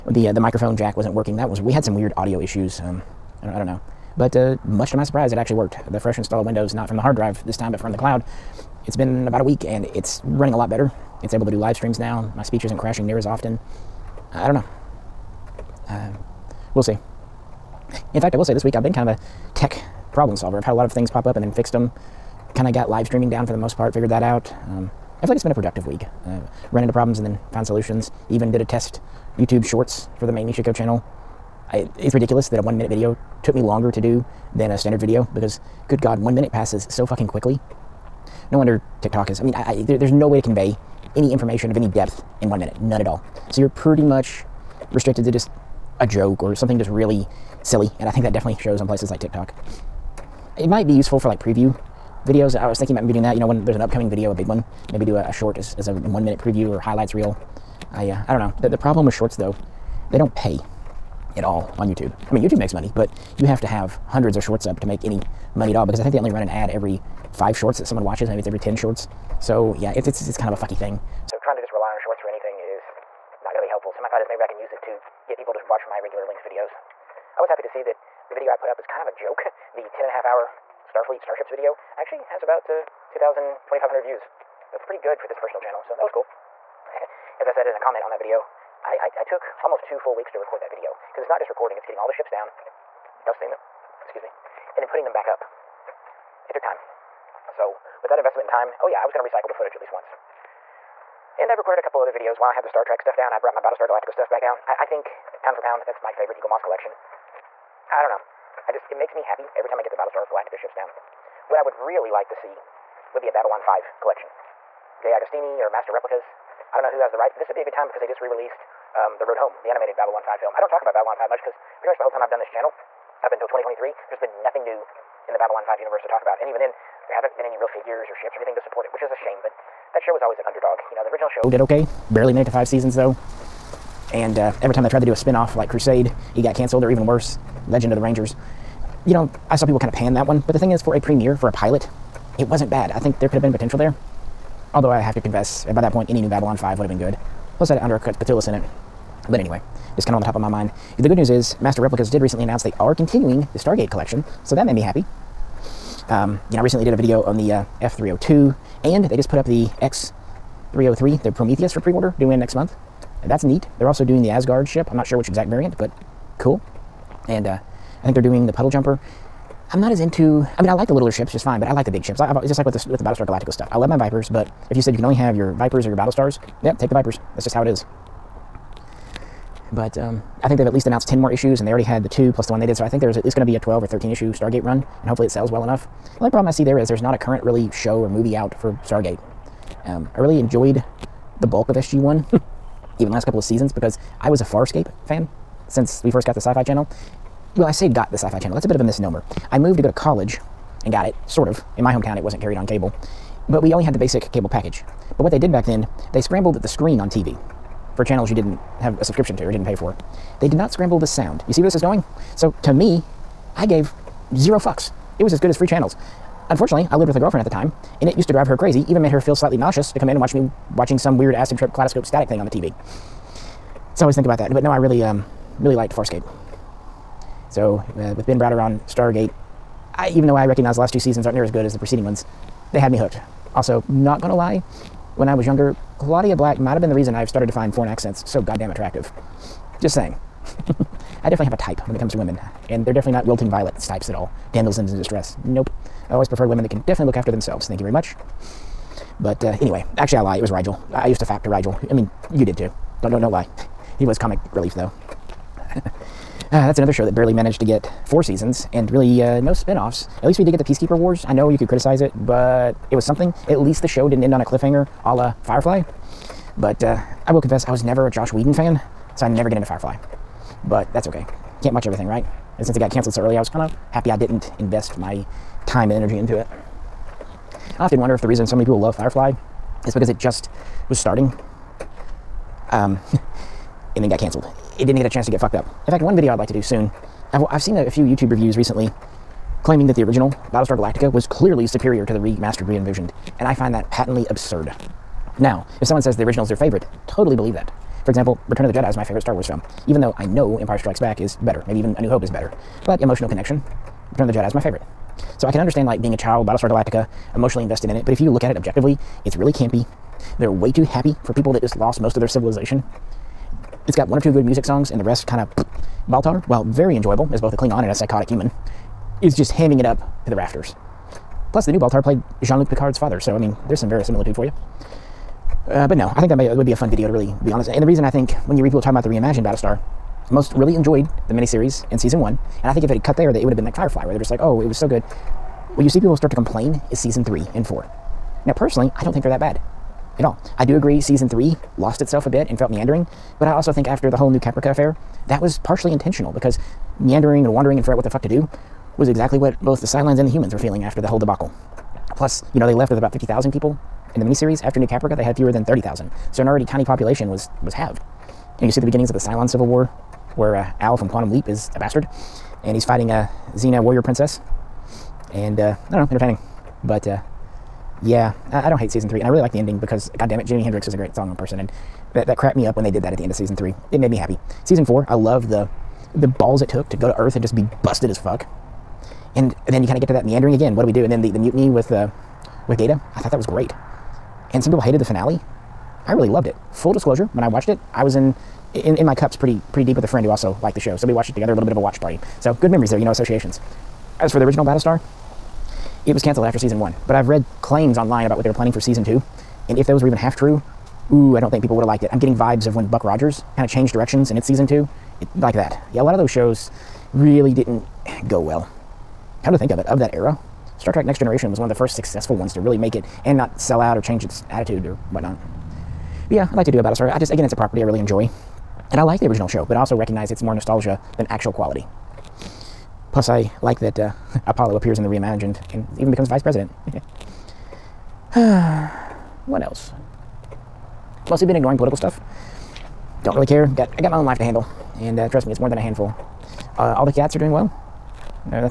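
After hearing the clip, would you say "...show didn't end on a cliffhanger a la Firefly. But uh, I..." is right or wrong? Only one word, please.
right.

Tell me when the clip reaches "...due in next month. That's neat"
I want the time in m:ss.
2:42.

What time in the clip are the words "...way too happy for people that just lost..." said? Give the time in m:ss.
5:10.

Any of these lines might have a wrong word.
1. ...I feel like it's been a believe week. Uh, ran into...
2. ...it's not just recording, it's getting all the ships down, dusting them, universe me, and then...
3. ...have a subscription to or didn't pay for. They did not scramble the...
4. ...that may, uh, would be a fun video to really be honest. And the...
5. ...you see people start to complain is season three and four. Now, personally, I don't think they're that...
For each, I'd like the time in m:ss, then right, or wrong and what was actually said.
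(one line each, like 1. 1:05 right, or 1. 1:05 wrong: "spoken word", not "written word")
1. 0:25 wrong: "productive", not "believe"
2. 1:31 wrong: "excuse", not "universe"
3. 3:28 right
4. 5:26 right
5. 5:35 right.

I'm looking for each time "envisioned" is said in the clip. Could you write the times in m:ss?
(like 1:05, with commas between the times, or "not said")
4:52.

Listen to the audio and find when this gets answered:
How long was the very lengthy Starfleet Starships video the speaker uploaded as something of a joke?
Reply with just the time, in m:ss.
1:19.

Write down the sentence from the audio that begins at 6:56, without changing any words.
But yeah, I'd like to do a Battlestar.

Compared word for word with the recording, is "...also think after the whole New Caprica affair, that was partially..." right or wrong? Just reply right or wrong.
right.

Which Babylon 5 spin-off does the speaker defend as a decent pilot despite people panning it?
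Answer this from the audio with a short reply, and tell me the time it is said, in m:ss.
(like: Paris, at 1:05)
Legend of the Rangers, at 2:17.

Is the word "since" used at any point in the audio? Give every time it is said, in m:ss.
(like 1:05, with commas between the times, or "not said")
3:15, 4:32.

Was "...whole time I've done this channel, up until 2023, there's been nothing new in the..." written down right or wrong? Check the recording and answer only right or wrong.
right.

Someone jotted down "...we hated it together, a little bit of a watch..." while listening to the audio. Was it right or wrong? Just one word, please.
wrong.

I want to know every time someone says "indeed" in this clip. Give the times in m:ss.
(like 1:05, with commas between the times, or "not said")
not said.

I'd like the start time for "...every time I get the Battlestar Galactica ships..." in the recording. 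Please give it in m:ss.
1:49.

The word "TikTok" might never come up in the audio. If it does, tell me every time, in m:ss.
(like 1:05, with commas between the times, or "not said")
0:39, 0:49.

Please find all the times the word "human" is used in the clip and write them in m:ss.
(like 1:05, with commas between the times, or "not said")
5:18, 5:50.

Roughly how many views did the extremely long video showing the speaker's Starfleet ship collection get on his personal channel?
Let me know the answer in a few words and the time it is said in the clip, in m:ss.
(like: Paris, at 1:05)
2,500, at 1:23.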